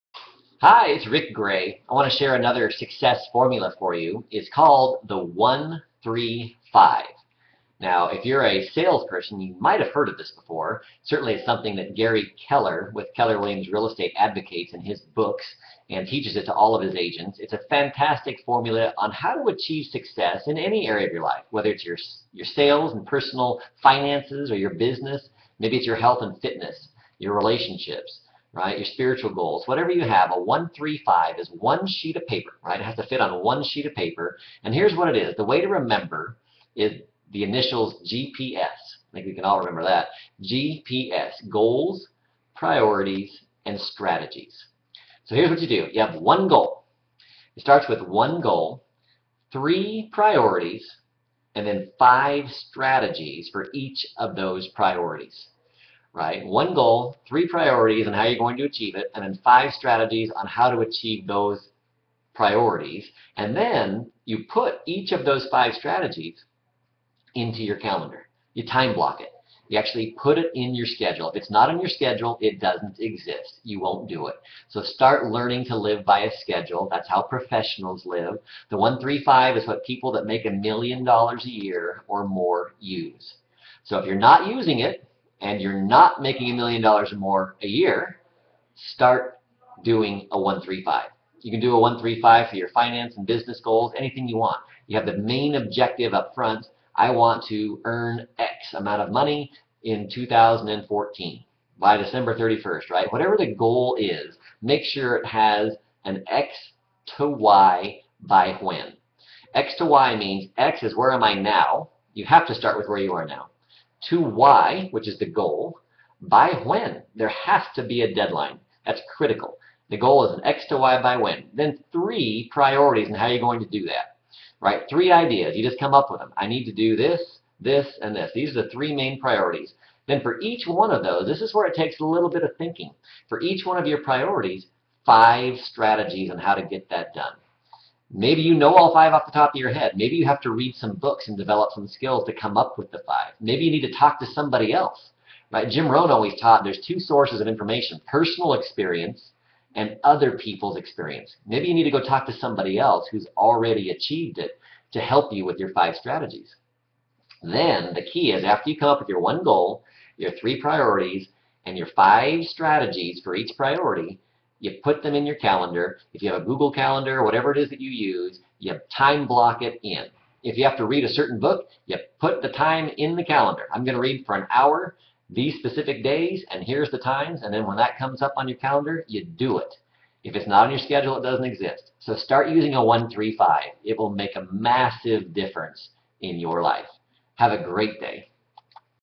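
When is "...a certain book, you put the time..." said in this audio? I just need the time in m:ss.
2:51.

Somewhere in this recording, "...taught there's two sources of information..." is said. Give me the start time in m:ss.
2:26.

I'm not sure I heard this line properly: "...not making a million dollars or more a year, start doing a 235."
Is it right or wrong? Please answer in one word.
wrong.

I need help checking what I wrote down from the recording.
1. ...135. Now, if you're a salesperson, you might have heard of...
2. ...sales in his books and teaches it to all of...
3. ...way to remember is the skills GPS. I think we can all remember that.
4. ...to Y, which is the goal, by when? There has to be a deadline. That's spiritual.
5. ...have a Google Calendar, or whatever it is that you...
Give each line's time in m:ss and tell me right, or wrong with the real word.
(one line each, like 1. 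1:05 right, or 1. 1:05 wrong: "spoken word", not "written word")
1. 0:05 right
2. 0:14 wrong: "advocates", not "sales"
3. 0:35 wrong: "initials", not "skills"
4. 1:54 wrong: "critical", not "spiritual"
5. 2:46 right.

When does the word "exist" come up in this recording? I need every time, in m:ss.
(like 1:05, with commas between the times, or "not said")
1:12, 3:01.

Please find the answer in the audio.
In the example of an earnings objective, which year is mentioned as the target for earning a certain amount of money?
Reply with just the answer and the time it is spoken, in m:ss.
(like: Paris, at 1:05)
2014, at 1:40.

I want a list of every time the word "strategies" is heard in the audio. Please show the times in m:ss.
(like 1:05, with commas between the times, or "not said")
0:43, 0:52, 0:59, 1:05, 2:15, 2:35, 2:42.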